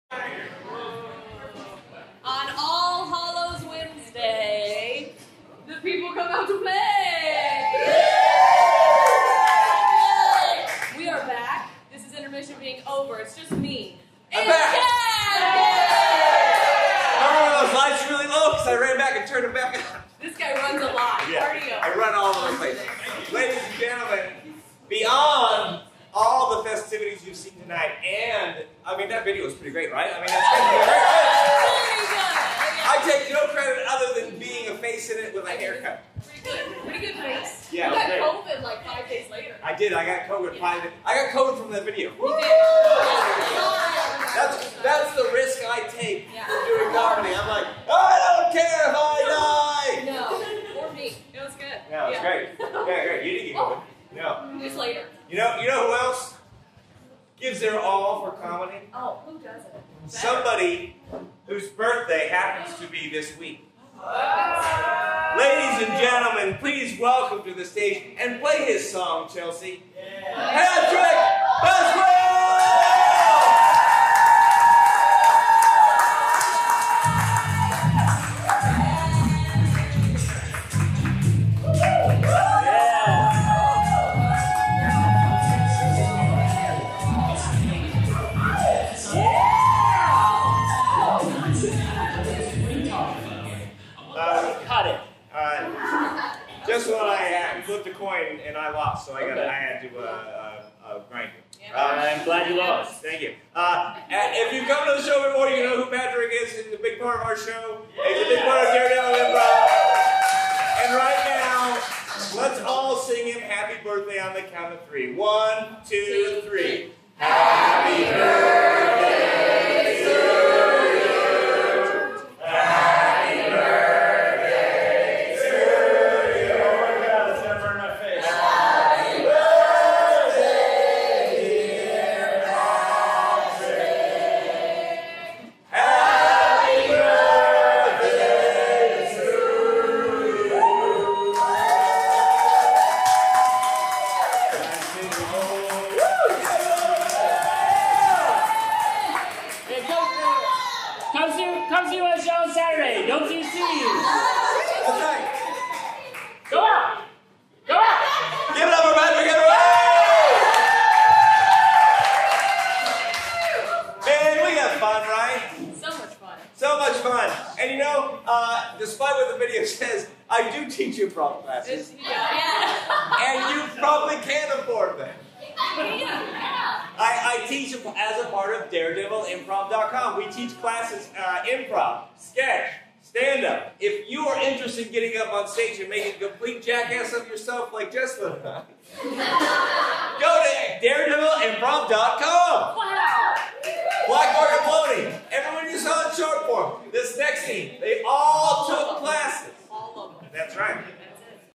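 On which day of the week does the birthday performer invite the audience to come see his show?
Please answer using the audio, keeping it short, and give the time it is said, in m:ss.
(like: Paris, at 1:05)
Saturday, at 2:32.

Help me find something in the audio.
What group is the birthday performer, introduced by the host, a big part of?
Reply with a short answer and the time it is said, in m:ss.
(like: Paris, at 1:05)
Daredevil Improv, at 1:48.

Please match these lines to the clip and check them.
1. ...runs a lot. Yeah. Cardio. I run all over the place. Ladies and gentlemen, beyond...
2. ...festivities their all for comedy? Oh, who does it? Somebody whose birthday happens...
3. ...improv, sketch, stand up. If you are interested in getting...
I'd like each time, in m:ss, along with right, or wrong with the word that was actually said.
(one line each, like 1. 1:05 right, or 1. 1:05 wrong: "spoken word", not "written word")
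1. 0:20 right
2. 0:57 wrong: "gives", not "festivities"
3. 3:01 right.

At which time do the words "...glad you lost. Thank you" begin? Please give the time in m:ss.
1:42.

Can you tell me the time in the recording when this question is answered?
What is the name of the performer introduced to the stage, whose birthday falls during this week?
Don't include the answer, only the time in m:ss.
1:10.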